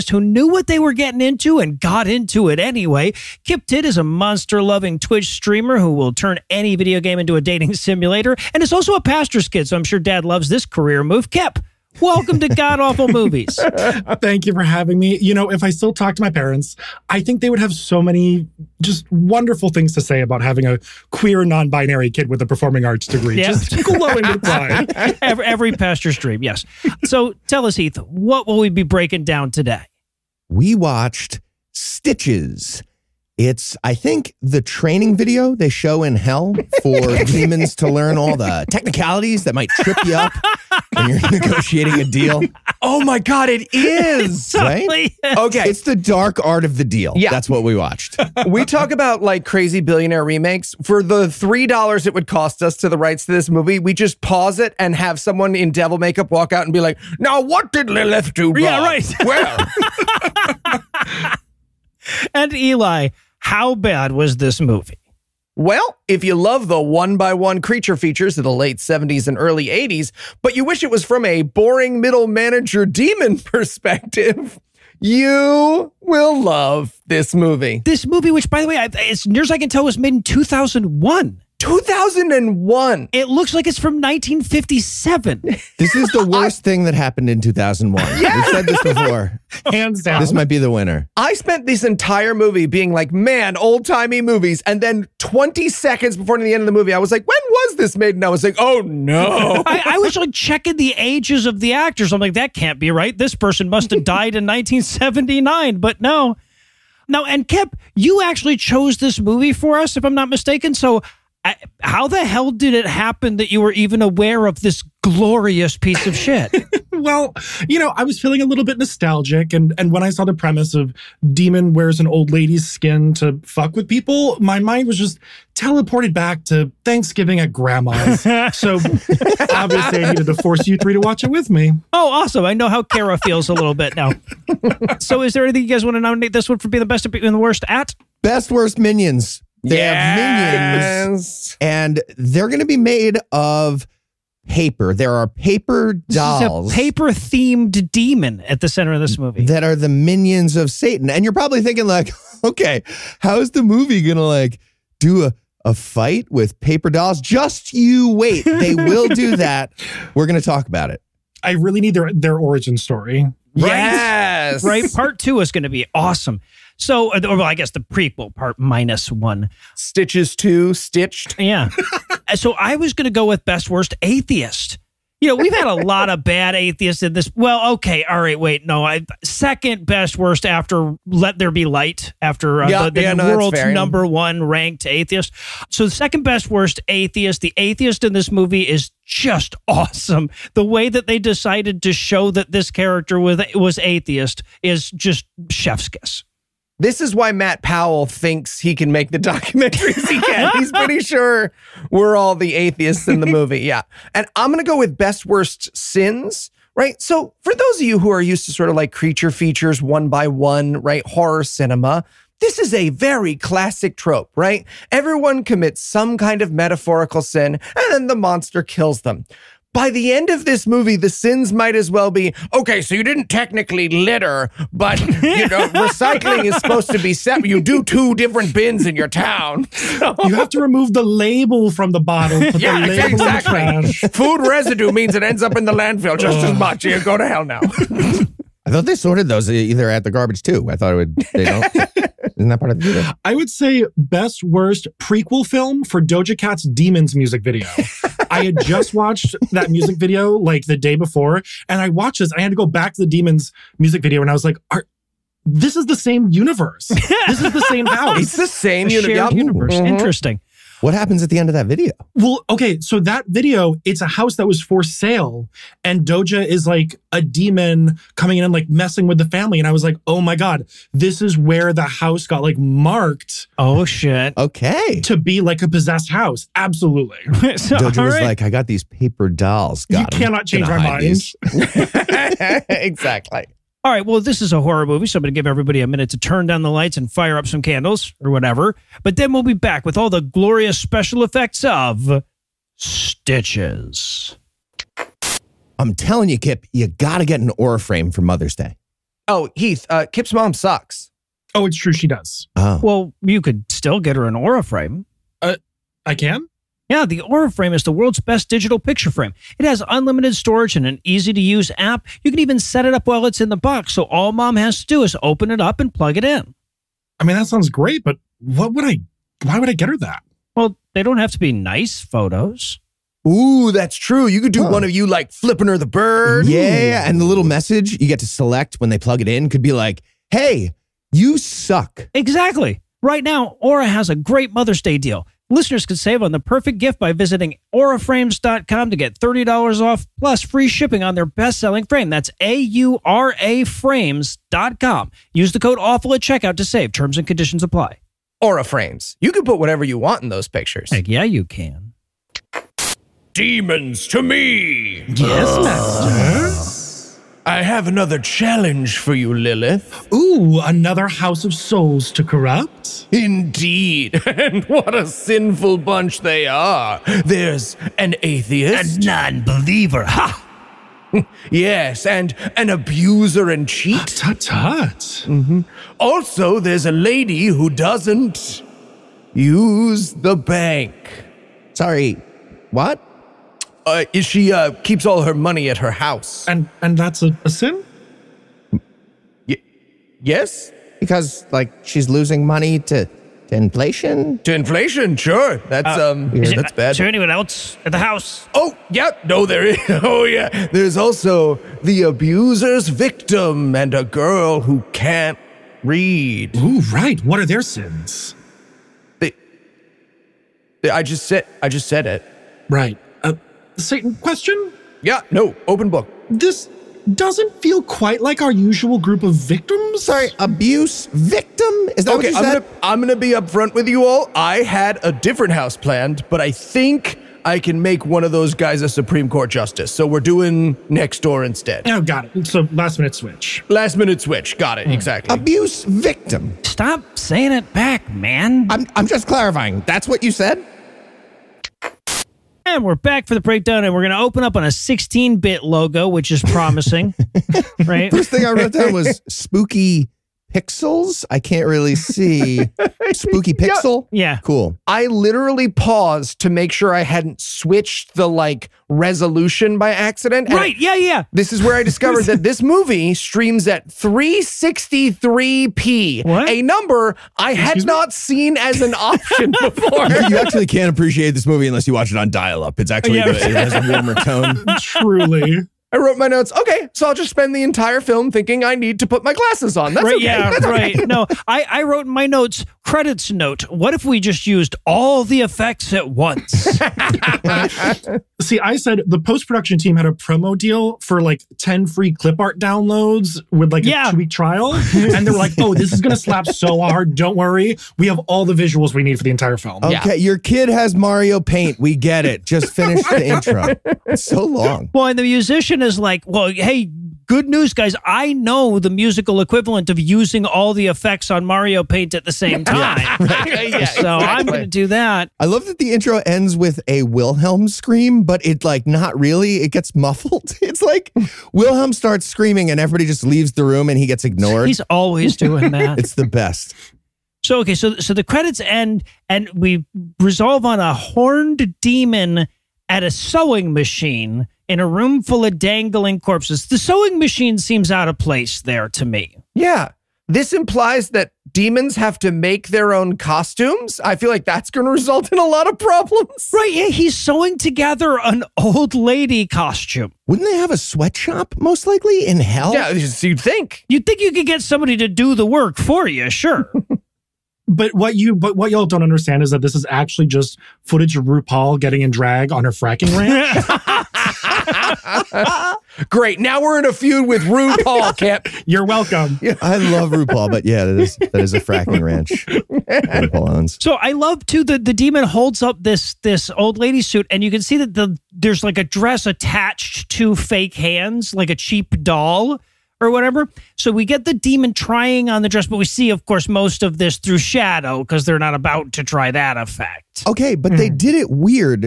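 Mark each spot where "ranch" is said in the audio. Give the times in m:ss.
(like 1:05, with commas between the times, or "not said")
9:23, 9:32.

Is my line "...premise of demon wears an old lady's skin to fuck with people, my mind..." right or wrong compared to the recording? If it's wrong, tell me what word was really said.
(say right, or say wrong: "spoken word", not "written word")
right.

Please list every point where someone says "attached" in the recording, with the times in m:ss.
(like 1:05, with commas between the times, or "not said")
9:39.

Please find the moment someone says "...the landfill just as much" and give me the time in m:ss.
3:55.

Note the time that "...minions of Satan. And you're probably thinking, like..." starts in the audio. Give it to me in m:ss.
2:29.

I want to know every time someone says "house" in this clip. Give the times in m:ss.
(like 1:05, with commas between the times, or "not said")
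4:17, 4:24, 4:31, 4:36, 6:01, 6:25, 6:37, 7:05.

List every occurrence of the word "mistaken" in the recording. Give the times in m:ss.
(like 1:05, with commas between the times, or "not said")
1:50.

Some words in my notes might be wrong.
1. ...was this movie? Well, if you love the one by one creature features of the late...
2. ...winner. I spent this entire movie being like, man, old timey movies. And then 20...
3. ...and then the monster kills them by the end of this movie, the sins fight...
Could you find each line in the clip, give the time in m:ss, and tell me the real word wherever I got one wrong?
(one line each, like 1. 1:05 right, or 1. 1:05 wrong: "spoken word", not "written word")
1. 1:04 right
2. 1:30 right
3. 3:37 wrong: "might", not "fight".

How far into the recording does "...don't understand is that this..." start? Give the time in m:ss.
9:18.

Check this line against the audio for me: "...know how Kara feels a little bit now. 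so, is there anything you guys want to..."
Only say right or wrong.
right.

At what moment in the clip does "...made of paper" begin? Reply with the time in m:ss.
2:22.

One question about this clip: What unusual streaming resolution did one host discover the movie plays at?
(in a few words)
363p.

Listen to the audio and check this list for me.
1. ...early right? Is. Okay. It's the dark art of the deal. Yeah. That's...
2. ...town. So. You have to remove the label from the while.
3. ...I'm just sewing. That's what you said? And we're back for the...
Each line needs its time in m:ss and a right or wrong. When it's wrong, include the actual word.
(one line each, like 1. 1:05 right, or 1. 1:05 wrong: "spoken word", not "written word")
1. 0:44 wrong: "totally", not "early"
2. 3:49 wrong: "bottle", not "while"
3. 7:18 wrong: "clarifying", not "sewing".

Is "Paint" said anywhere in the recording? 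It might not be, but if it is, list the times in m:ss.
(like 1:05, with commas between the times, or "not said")
8:21, 8:31.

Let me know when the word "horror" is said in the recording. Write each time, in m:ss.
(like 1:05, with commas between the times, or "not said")
3:31, 4:44.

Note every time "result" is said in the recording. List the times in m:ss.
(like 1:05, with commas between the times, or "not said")
9:04.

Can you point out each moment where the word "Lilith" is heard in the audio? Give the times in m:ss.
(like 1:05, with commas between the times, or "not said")
0:57, 5:59.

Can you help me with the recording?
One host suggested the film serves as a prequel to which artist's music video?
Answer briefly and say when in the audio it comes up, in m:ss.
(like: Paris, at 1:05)
Doja Cat, at 4:06.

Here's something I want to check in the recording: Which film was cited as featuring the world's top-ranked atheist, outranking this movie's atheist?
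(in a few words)
Let There Be Light.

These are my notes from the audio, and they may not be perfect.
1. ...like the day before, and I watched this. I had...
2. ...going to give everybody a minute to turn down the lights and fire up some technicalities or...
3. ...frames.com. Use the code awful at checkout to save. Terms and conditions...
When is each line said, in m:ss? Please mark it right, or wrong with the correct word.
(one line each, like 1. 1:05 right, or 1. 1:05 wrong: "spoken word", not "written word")
1. 4:10 right
2. 4:45 wrong: "candles", not "technicalities"
3. 5:43 right.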